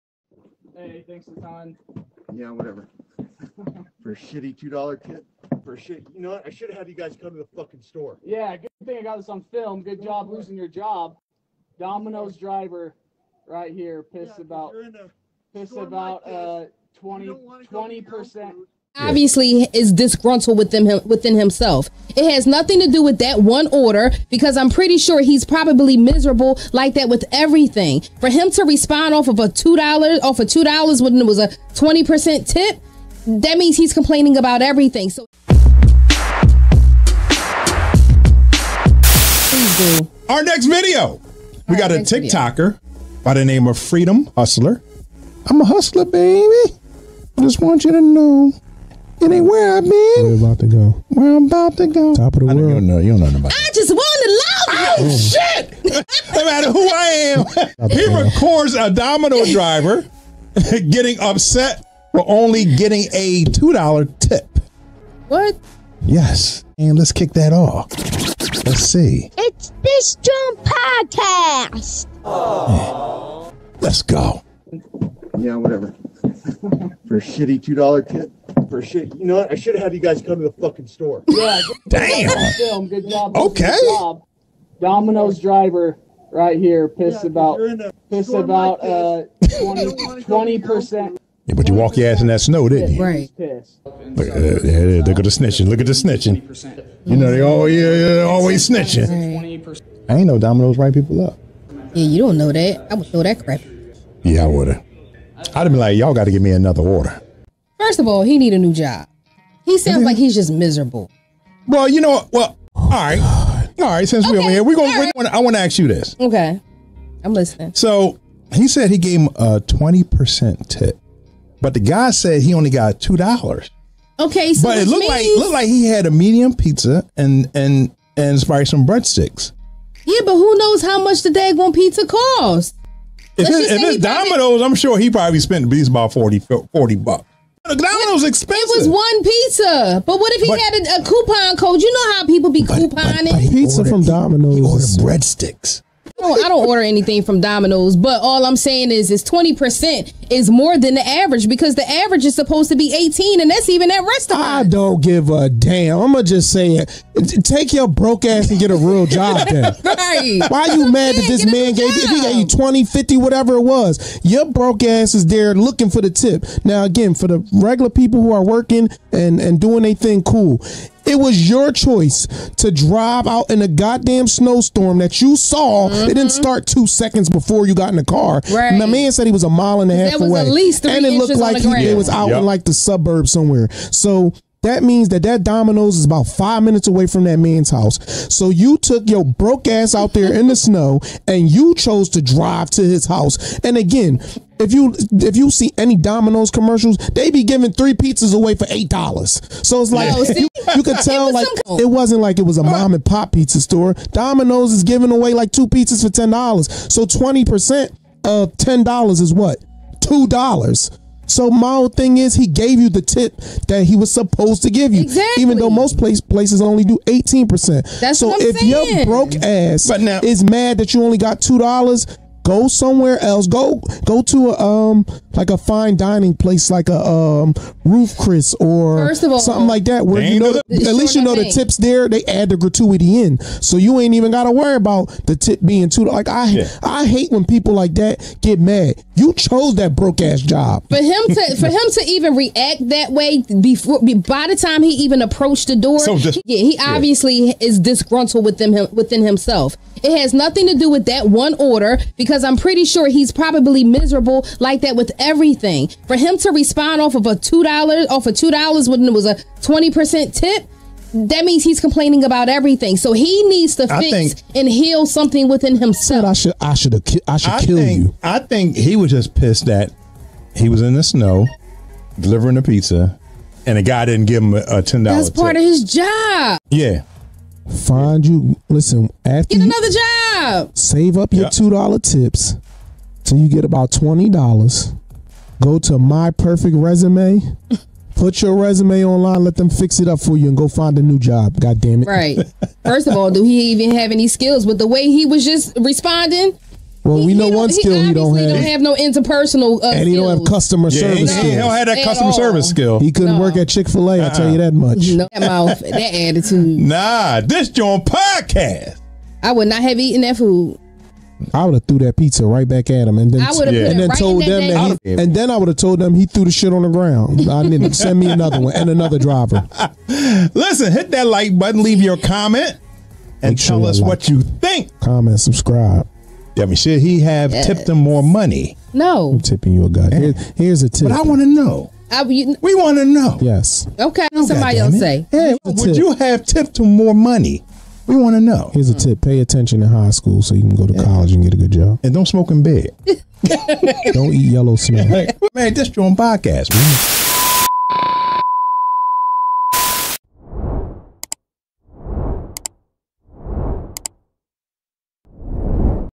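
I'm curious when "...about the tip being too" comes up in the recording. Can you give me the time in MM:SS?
03:54.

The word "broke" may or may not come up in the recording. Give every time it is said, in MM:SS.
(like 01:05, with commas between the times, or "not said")
02:37, 02:44, 03:09, 03:39, 03:59.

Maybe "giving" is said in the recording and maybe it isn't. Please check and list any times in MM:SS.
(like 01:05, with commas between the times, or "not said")
03:17, 03:24.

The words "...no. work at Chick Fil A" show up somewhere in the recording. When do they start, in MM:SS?
05:03.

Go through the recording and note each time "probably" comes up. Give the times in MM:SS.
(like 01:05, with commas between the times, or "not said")
00:25, 02:08, 02:15, 04:13.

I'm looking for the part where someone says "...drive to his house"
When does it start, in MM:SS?
03:12.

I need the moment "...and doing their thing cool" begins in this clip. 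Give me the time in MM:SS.
02:49.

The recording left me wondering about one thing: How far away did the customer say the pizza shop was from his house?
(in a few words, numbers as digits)
A mile and a half.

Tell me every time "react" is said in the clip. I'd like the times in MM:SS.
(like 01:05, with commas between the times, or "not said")
04:02.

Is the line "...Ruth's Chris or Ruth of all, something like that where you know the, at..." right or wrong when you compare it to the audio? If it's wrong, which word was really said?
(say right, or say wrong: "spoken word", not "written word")
wrong: "First", not "Ruth".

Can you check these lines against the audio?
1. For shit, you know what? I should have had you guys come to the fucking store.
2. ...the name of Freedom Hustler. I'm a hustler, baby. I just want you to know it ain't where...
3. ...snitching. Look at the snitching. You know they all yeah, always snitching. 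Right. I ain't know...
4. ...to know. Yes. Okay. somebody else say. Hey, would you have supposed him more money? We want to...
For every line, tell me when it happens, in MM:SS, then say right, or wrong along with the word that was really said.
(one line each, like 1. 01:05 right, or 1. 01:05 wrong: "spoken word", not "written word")
1. 00:05 right
2. 00:43 right
3. 01:35 right
4. 05:32 wrong: "tipped", not "supposed".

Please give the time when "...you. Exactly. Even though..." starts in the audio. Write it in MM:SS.
03:34.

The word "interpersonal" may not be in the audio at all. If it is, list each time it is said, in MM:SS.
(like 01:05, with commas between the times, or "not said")
04:58.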